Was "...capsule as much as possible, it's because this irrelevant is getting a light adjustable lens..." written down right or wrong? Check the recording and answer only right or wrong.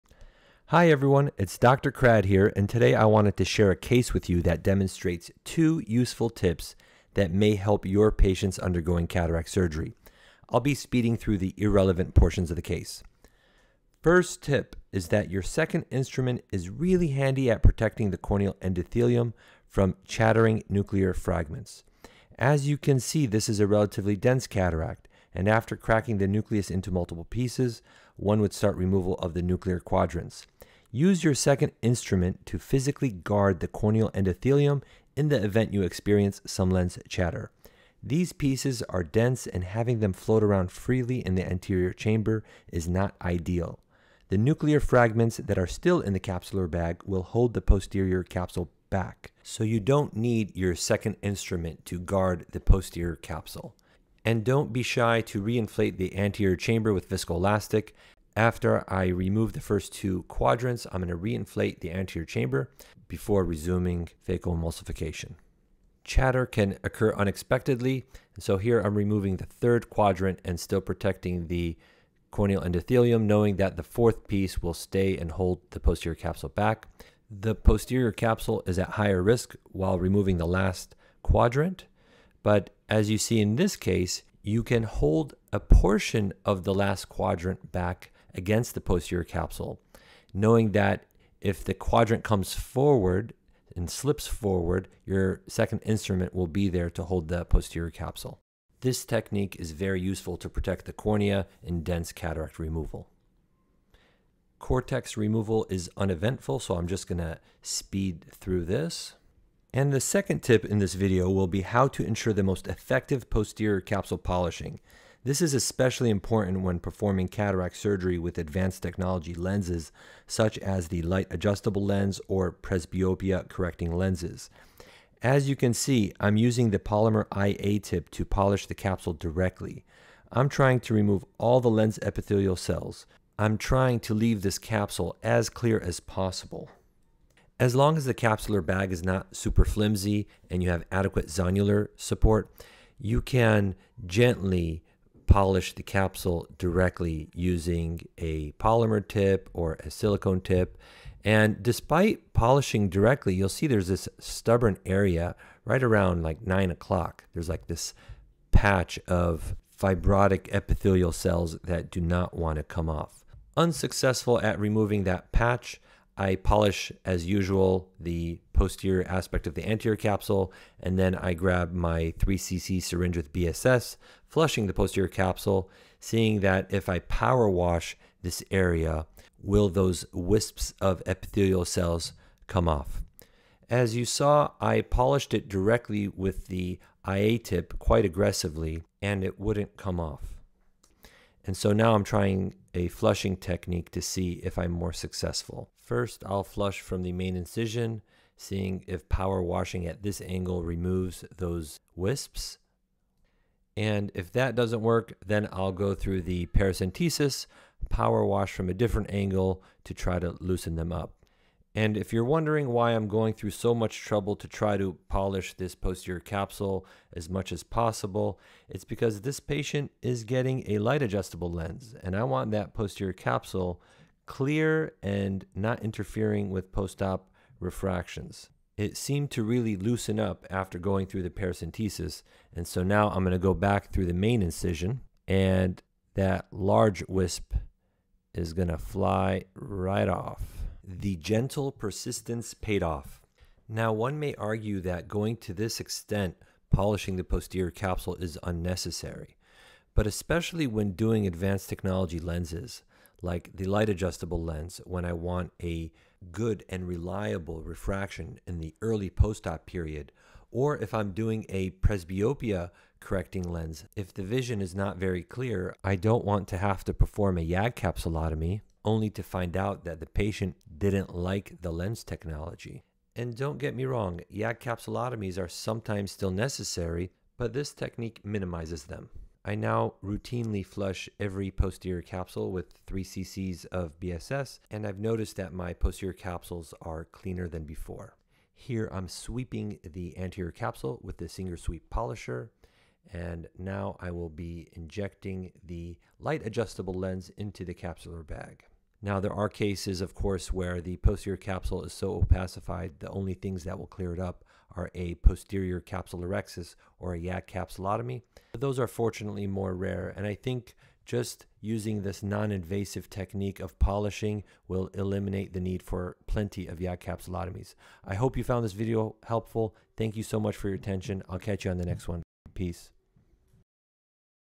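wrong.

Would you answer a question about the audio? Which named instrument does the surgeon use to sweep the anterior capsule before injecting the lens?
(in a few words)
Singer Sweep Polisher.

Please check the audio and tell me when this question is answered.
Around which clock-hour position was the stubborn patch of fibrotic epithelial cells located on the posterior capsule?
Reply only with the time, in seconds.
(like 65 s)
156 s.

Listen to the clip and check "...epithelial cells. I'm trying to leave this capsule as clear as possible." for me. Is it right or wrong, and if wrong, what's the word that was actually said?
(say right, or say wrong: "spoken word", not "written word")
right.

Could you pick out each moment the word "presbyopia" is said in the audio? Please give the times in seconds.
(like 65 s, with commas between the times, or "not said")
122 s, 261 s.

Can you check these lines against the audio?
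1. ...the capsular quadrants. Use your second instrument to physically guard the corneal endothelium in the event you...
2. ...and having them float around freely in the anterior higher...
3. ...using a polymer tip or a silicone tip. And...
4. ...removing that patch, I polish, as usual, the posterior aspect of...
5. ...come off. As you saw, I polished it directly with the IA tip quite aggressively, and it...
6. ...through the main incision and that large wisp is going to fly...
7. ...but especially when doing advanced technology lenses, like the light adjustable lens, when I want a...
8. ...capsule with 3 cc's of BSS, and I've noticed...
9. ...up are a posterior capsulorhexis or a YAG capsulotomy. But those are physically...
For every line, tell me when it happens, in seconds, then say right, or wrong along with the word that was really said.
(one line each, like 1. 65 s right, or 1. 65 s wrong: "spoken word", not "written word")
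1. 29 s wrong: "nuclear", not "capsular"
2. 39 s wrong: "chamber", not "higher"
3. 147 s right
4. 164 s right
5. 182 s right
6. 233 s right
7. 249 s right
8. 282 s right
9. 304 s wrong: "fortunately", not "physically".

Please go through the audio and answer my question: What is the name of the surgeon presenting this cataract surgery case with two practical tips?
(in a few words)
Dr. Krad.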